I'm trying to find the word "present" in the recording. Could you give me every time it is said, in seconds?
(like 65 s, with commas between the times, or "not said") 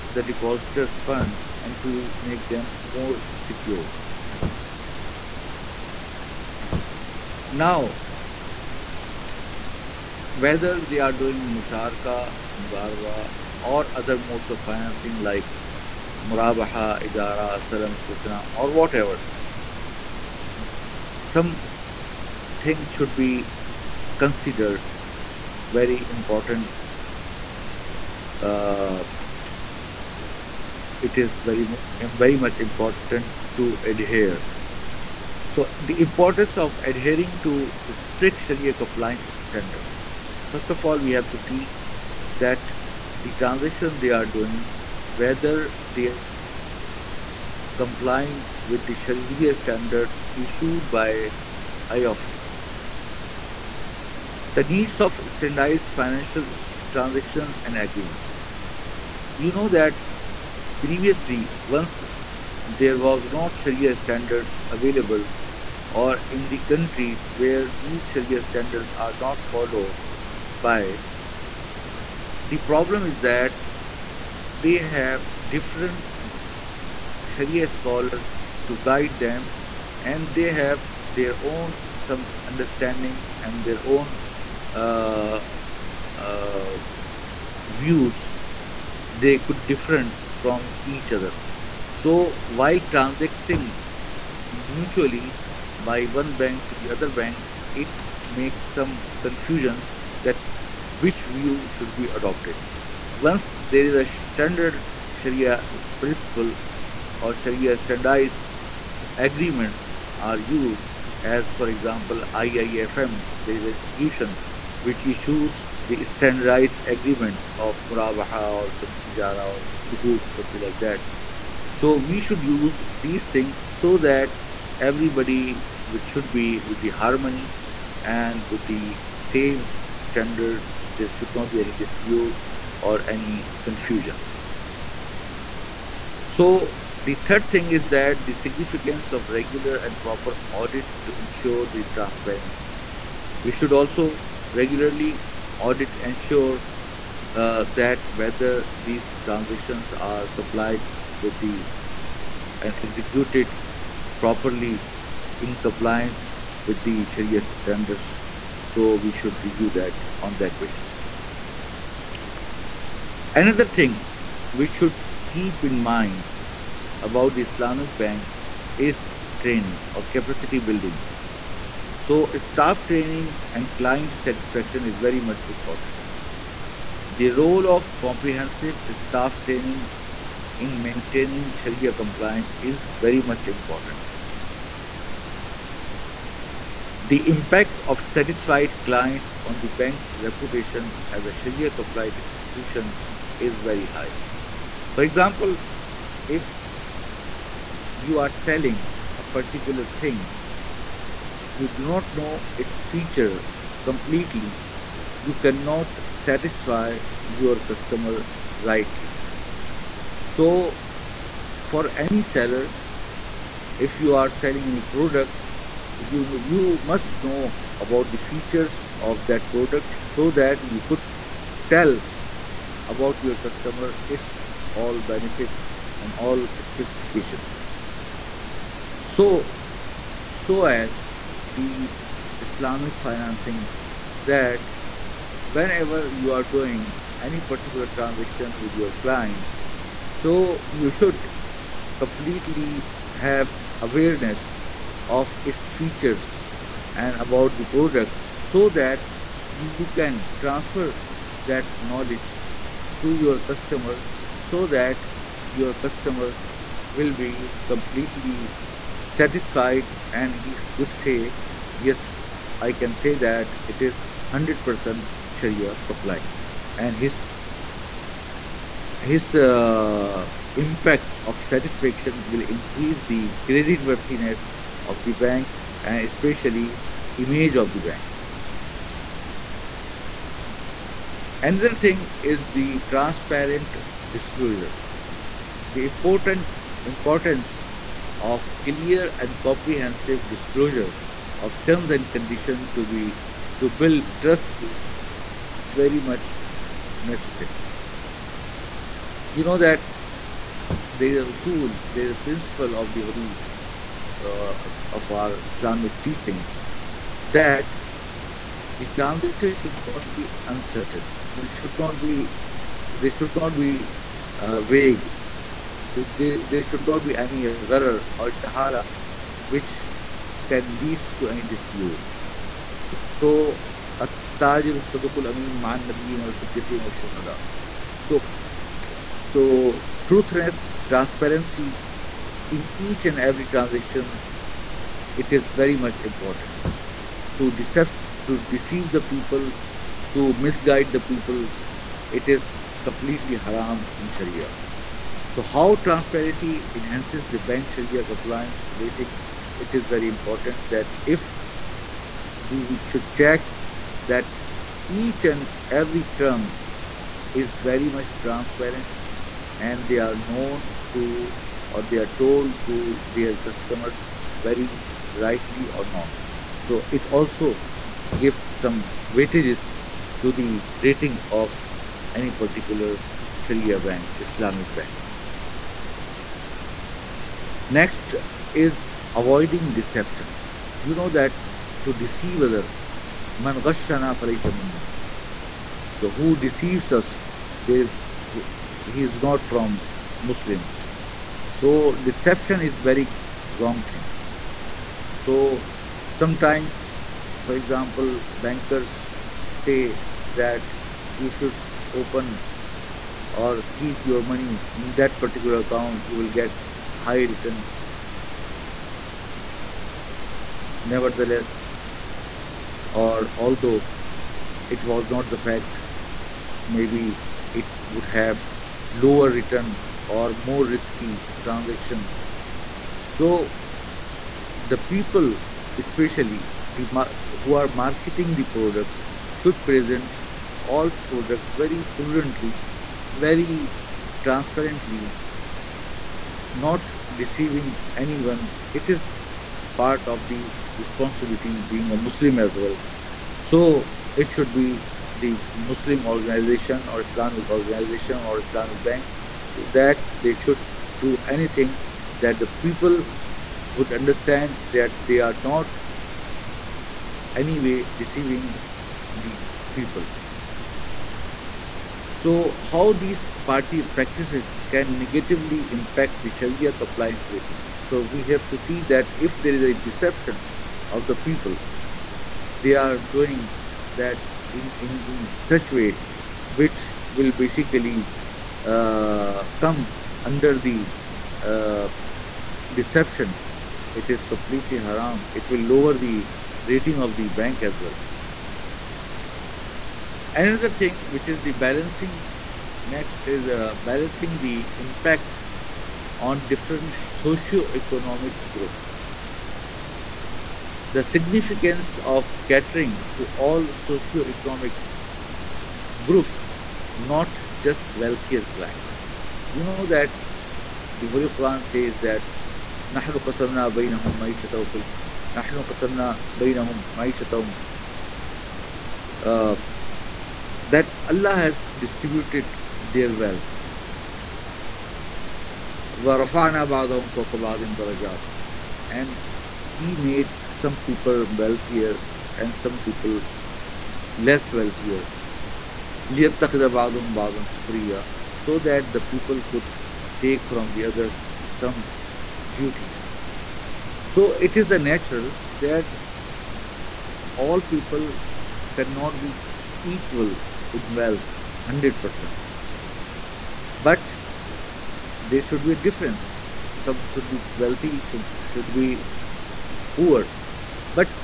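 429 s.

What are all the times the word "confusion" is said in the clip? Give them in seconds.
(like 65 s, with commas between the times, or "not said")
99 s, 133 s.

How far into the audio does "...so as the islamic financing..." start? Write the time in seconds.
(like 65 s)
230 s.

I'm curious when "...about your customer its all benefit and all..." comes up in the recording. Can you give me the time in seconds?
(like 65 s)
222 s.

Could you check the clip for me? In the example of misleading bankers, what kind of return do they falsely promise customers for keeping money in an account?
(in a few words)
high return.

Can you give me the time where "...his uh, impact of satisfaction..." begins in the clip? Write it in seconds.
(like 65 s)
269 s.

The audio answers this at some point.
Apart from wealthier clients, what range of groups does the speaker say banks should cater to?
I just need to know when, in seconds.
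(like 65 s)
503 s.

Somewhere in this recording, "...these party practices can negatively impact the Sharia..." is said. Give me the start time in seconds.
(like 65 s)
462 s.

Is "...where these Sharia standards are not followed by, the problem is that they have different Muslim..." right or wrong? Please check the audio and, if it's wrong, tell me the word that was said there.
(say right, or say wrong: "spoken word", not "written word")
wrong: "Sharia", not "Muslim".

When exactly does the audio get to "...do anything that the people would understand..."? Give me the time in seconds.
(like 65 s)
451 s.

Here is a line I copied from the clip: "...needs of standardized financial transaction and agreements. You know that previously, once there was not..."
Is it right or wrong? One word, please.
right.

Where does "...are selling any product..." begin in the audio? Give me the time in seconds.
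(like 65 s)
214 s.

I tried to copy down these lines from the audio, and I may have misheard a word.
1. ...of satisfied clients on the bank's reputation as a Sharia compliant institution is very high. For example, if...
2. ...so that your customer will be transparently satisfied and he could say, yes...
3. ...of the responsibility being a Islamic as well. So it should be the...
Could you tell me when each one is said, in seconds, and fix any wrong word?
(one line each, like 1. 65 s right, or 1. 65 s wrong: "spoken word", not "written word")
1. 187 s right
2. 254 s wrong: "completely", not "transparently"
3. 440 s wrong: "Muslim", not "Islamic".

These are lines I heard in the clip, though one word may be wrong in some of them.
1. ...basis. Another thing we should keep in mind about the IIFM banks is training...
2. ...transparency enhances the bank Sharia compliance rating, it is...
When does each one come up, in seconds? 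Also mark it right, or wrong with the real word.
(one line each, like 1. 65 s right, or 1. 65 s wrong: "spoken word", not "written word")
1. 160 s wrong: "Islamic", not "IIFM"
2. 345 s right.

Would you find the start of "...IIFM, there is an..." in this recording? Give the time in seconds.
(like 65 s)
112 s.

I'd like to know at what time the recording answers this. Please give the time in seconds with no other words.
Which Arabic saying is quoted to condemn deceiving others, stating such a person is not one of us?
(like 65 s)
383 s.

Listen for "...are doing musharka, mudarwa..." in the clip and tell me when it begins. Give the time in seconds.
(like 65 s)
10 s.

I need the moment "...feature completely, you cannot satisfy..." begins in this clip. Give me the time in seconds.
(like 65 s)
202 s.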